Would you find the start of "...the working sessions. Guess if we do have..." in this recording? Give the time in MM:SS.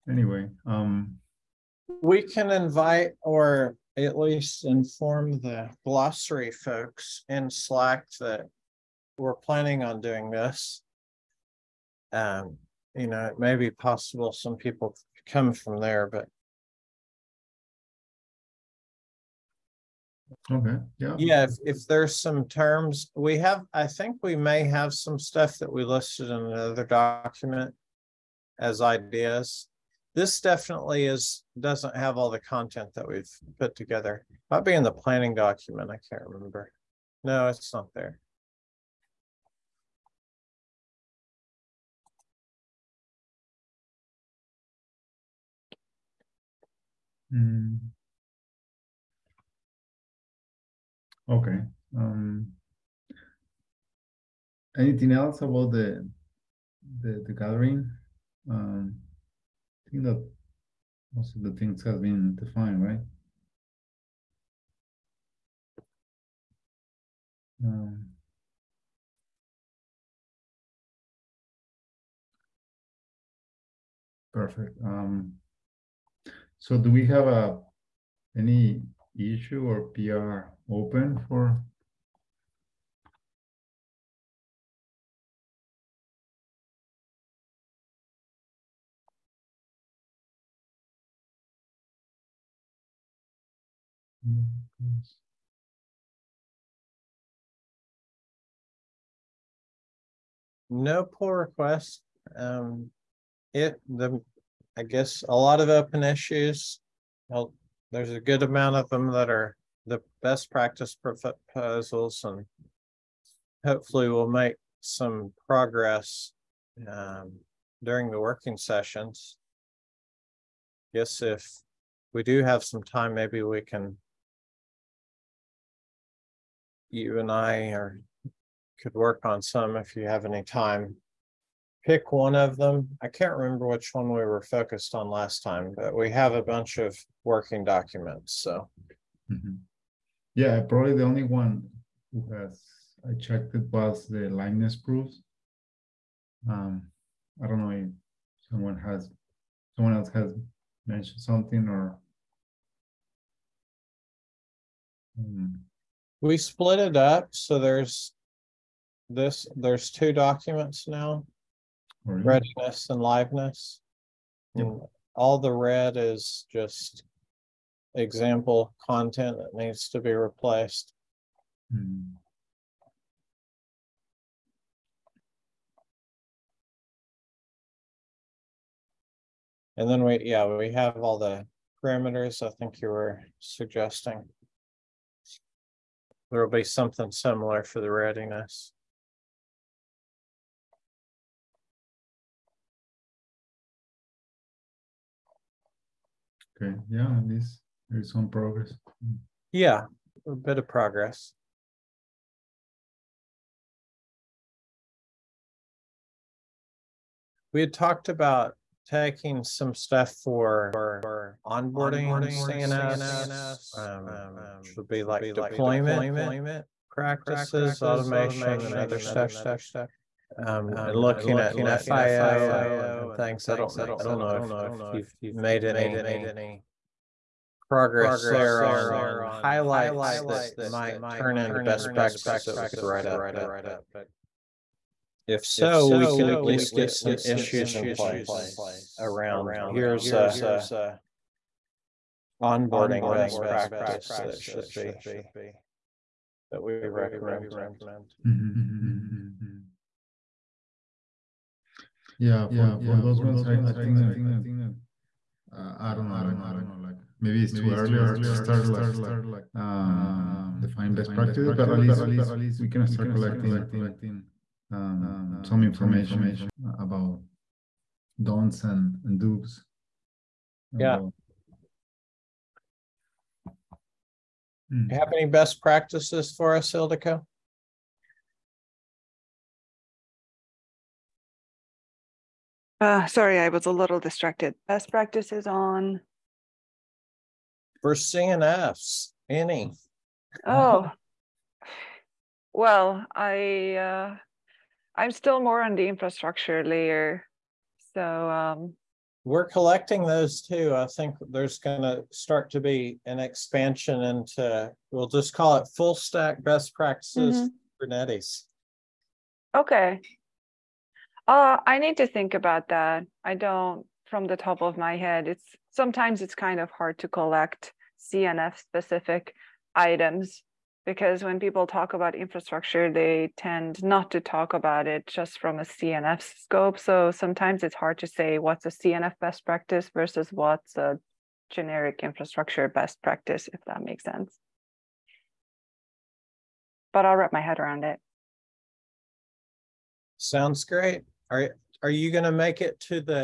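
01:58.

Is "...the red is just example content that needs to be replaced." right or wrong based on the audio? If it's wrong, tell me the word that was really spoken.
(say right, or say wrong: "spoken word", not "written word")
right.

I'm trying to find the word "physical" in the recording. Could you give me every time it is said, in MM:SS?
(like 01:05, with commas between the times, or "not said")
not said.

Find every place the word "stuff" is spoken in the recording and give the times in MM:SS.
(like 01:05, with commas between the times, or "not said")
00:25, 03:29, 03:38.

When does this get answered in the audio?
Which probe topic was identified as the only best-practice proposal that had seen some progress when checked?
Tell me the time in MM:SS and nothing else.
02:24.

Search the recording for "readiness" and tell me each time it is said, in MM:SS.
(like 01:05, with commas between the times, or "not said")
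02:42, 03:07.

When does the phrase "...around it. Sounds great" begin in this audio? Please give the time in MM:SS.
05:37.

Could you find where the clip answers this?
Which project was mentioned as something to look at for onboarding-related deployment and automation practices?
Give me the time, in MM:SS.
03:41.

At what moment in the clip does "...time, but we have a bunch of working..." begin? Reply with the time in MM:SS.
02:15.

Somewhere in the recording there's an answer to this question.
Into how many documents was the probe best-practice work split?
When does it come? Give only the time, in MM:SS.
02:39.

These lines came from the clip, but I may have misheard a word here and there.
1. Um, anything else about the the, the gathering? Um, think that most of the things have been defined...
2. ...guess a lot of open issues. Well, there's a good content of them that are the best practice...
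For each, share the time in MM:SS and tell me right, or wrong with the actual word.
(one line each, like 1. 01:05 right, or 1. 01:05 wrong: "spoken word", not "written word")
1. 00:51 right
2. 01:44 wrong: "amount", not "content".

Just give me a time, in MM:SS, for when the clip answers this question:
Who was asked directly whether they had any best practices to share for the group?
04:36.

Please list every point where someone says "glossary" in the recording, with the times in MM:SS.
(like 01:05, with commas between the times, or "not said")
00:05.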